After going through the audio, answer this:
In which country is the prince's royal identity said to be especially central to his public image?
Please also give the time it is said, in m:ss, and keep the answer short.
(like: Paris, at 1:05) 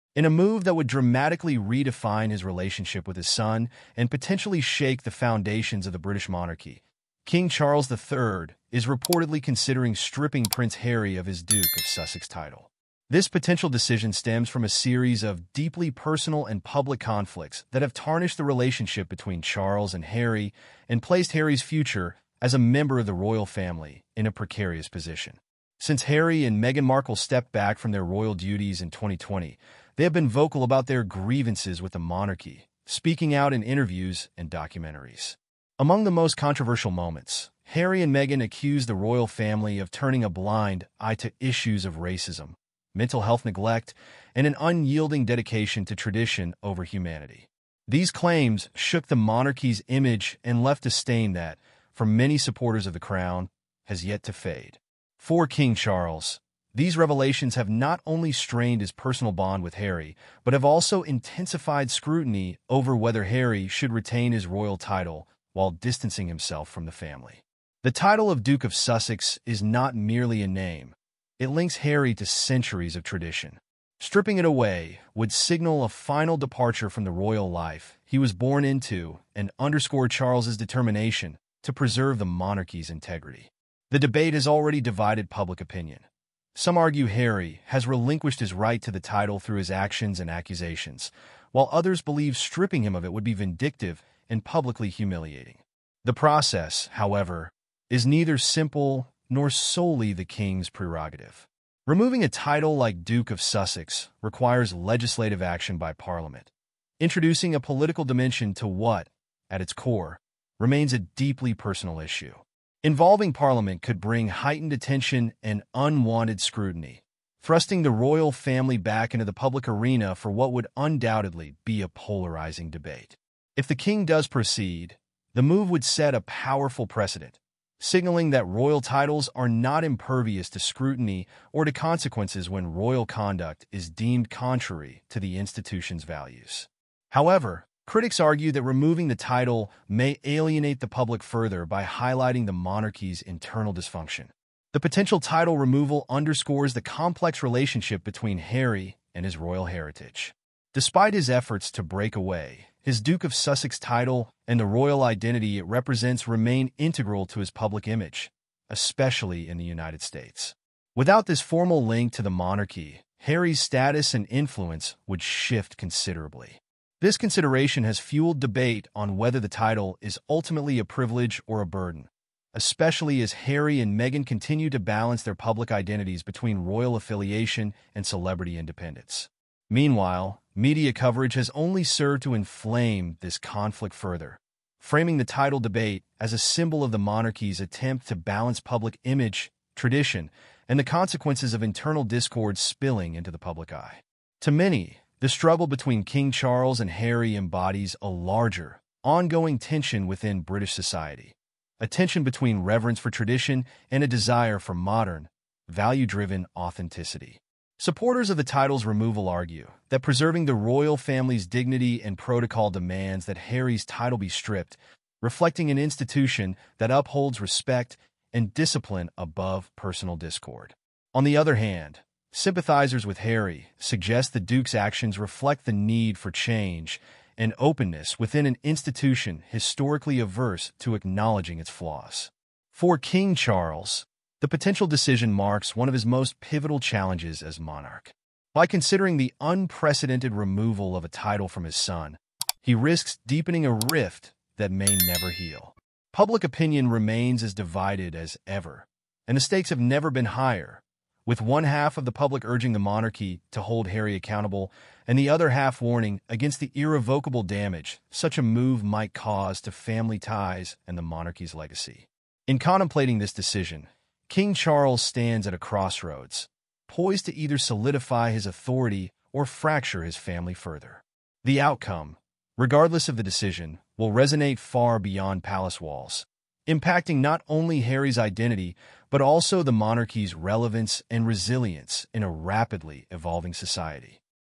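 United States, at 2:39.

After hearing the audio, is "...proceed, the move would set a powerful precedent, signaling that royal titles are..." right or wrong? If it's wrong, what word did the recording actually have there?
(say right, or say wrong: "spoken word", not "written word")
right.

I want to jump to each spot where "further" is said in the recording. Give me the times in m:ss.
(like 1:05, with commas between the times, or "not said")
2:21, 3:03, 4:30.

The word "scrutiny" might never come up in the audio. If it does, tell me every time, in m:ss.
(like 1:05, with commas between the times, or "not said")
1:01, 1:56, 2:10.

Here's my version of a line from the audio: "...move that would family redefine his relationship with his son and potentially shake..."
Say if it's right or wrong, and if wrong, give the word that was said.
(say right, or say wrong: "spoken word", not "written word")
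wrong: "dramatically", not "family".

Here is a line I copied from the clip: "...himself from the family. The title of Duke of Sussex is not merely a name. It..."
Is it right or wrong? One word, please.
right.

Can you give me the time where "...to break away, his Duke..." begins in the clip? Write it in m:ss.
2:31.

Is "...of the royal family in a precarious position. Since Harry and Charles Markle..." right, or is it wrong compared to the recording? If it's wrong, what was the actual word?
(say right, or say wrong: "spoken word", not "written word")
wrong: "Meghan", not "Charles".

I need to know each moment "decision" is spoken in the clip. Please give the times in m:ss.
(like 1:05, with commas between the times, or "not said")
0:13, 3:54, 4:23, 4:33.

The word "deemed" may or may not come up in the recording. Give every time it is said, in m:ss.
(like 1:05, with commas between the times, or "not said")
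2:13.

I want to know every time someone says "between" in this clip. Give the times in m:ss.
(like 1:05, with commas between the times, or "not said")
0:19, 2:28, 2:56, 3:15, 3:22.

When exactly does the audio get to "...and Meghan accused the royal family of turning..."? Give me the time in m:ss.
0:38.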